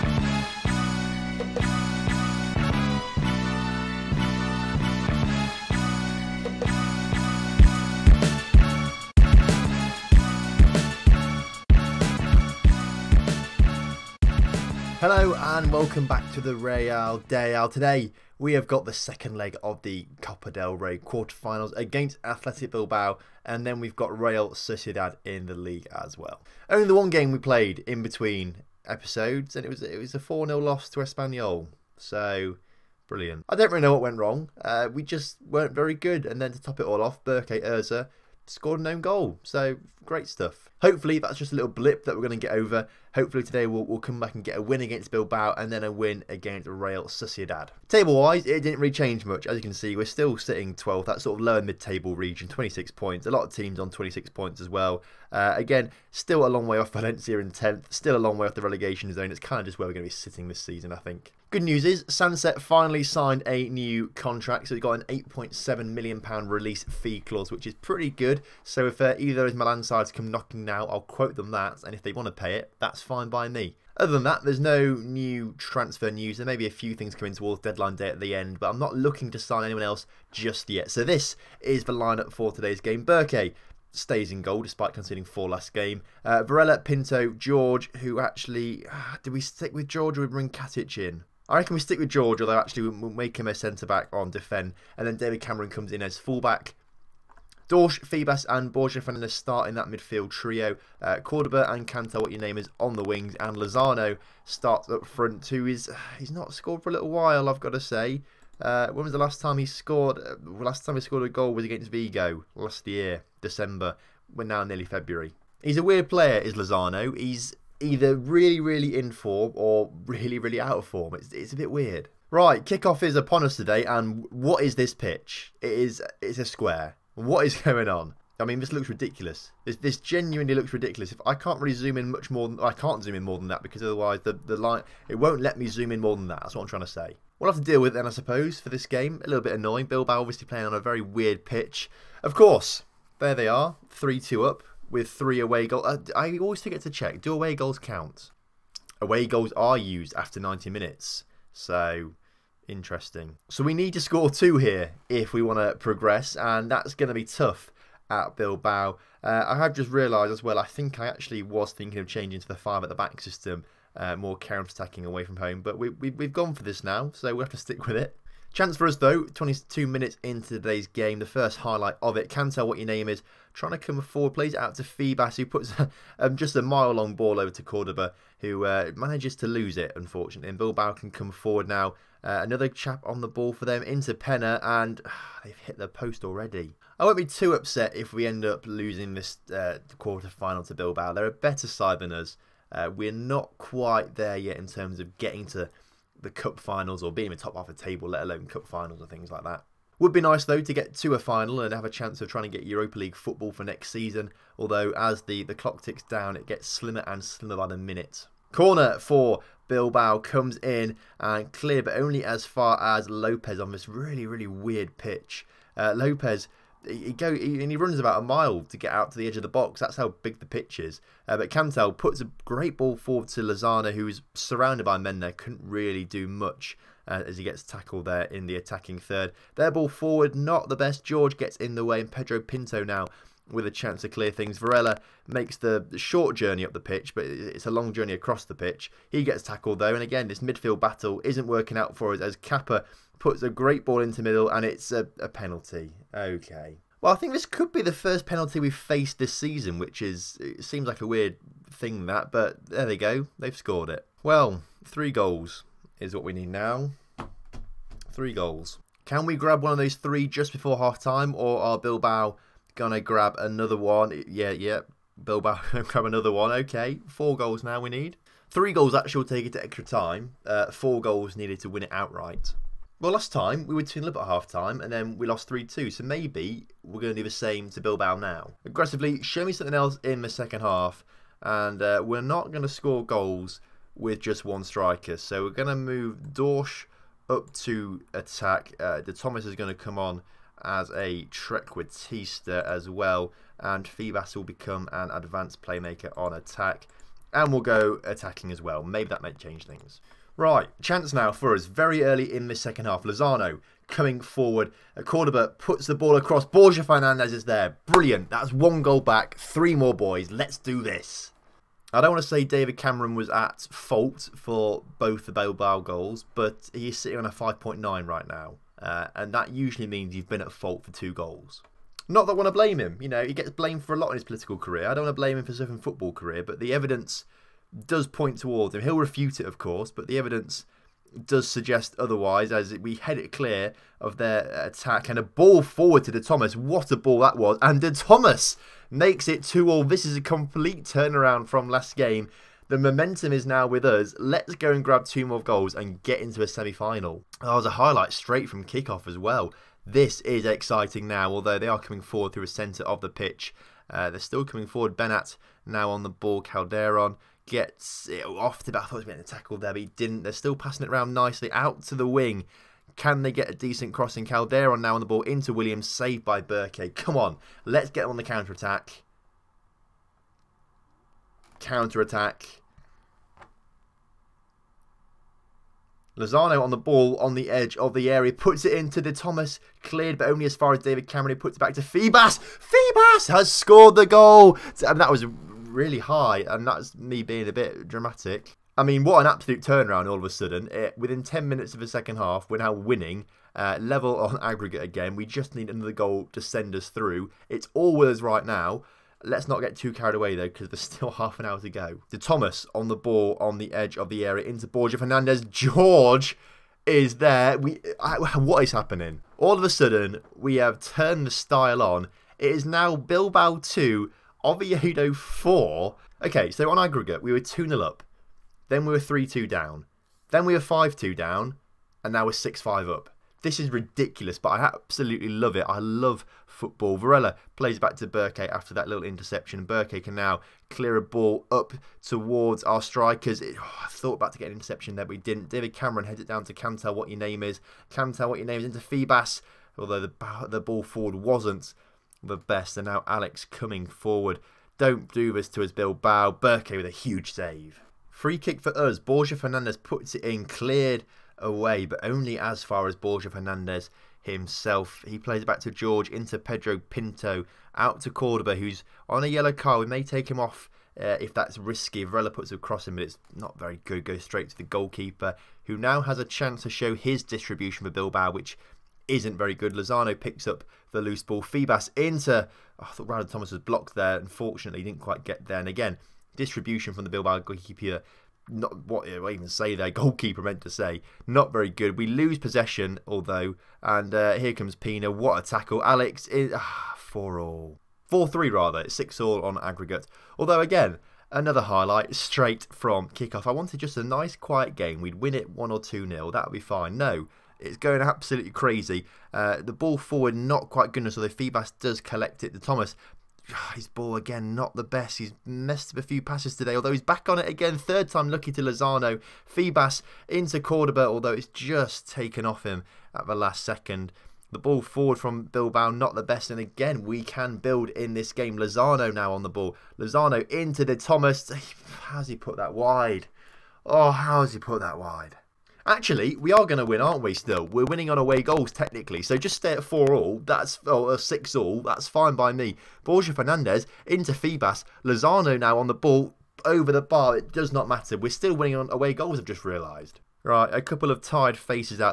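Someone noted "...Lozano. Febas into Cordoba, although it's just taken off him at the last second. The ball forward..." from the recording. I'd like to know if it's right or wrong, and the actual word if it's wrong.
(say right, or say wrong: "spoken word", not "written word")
right.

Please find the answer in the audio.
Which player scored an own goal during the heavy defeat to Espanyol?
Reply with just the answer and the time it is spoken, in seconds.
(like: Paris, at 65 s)
Berke Erza, at 37 s.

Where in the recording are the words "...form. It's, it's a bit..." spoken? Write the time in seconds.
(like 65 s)
120 s.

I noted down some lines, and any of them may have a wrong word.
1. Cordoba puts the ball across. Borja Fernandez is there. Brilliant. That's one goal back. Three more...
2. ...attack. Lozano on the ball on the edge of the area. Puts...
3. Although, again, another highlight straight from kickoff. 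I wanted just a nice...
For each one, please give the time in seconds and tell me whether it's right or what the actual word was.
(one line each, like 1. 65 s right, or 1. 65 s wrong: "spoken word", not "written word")
1. 305 s right
2. 372 s right
3. 490 s right.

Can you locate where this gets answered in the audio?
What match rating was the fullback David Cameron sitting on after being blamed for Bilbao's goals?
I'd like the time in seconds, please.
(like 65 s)
317 s.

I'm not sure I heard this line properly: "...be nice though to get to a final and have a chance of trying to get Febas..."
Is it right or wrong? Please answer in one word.
wrong.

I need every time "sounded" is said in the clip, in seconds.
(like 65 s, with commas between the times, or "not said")
not said.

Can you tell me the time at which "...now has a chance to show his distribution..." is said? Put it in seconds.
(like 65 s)
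465 s.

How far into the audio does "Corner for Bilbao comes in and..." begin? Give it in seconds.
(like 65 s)
208 s.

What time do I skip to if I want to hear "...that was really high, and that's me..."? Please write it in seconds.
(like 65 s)
384 s.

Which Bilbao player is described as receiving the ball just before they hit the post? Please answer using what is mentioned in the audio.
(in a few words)
Penner.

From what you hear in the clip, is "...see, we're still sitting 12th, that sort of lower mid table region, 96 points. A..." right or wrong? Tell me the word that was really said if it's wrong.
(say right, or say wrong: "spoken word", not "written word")
wrong: "26", not "96".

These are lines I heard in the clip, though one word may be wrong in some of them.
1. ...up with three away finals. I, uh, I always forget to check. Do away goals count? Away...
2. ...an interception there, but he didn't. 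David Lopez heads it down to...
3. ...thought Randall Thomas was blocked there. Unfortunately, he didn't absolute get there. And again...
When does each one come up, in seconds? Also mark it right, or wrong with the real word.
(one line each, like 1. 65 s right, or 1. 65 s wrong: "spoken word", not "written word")
1. 144 s wrong: "goals", not "finals"
2. 434 s wrong: "Cameron", not "Lopez"
3. 472 s wrong: "quite", not "absolute".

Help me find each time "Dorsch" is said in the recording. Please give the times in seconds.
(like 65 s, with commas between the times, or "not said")
97 s, 286 s.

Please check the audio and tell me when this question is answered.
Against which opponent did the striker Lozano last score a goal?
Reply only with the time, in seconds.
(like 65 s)
111 s.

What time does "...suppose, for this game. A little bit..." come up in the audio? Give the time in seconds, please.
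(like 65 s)
138 s.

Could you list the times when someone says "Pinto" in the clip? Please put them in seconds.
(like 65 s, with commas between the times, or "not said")
86 s, 232 s, 456 s.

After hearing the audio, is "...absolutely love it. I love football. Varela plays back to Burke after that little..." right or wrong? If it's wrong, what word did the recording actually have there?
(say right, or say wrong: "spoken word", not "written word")
right.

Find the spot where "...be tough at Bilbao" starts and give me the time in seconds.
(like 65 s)
157 s.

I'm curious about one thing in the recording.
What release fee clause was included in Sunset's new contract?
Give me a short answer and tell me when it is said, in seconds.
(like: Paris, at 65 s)
£8.7 million, at 65 s.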